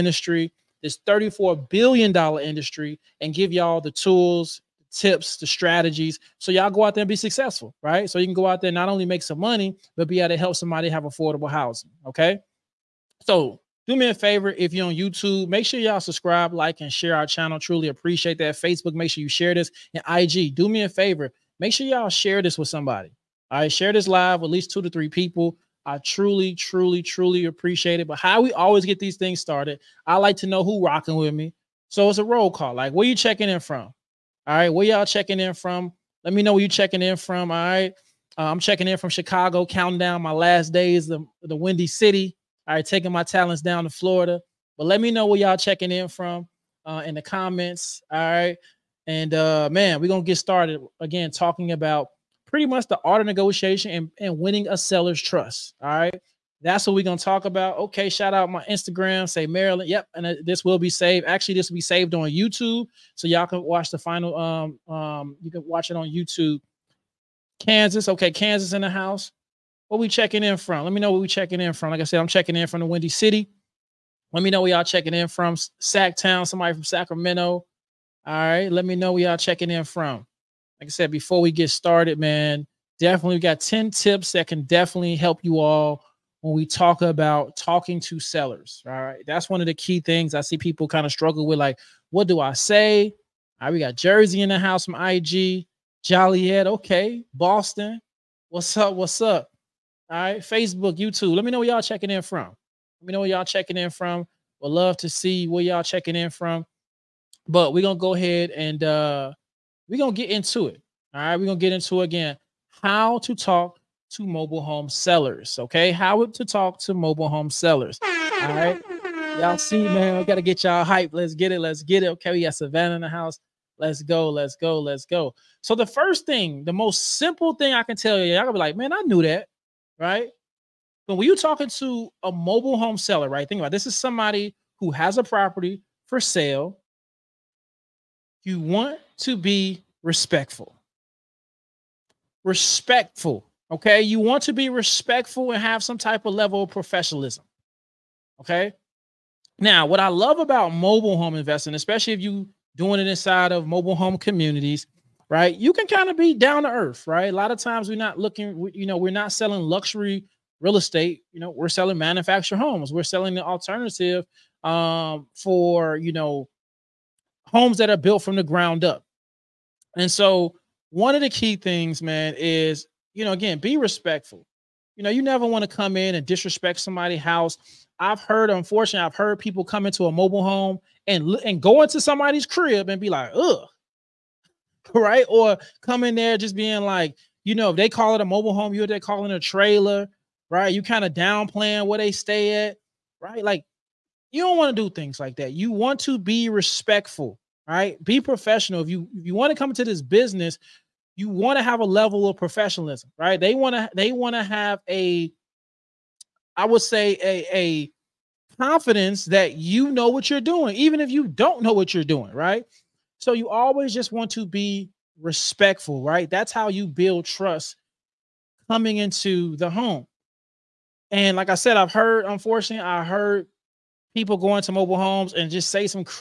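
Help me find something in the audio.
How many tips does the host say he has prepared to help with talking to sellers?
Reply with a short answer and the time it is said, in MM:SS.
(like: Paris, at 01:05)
10, at 01:23.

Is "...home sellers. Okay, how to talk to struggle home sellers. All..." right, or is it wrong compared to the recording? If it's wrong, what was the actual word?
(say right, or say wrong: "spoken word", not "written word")
wrong: "mobile", not "struggle".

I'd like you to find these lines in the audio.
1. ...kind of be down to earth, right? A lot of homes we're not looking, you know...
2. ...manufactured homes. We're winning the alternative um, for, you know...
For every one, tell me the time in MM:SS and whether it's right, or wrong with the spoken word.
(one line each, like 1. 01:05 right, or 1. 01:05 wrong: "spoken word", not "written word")
1. 02:35 wrong: "times", not "homes"
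2. 02:41 wrong: "selling", not "winning".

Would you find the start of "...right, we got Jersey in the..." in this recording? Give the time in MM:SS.
01:33.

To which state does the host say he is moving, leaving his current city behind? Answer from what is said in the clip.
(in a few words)
Florida.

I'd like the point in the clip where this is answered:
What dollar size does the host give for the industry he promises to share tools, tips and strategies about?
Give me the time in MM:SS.
00:01.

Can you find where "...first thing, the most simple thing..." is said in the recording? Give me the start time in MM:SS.
02:05.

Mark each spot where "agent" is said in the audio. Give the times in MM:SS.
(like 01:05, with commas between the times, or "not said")
not said.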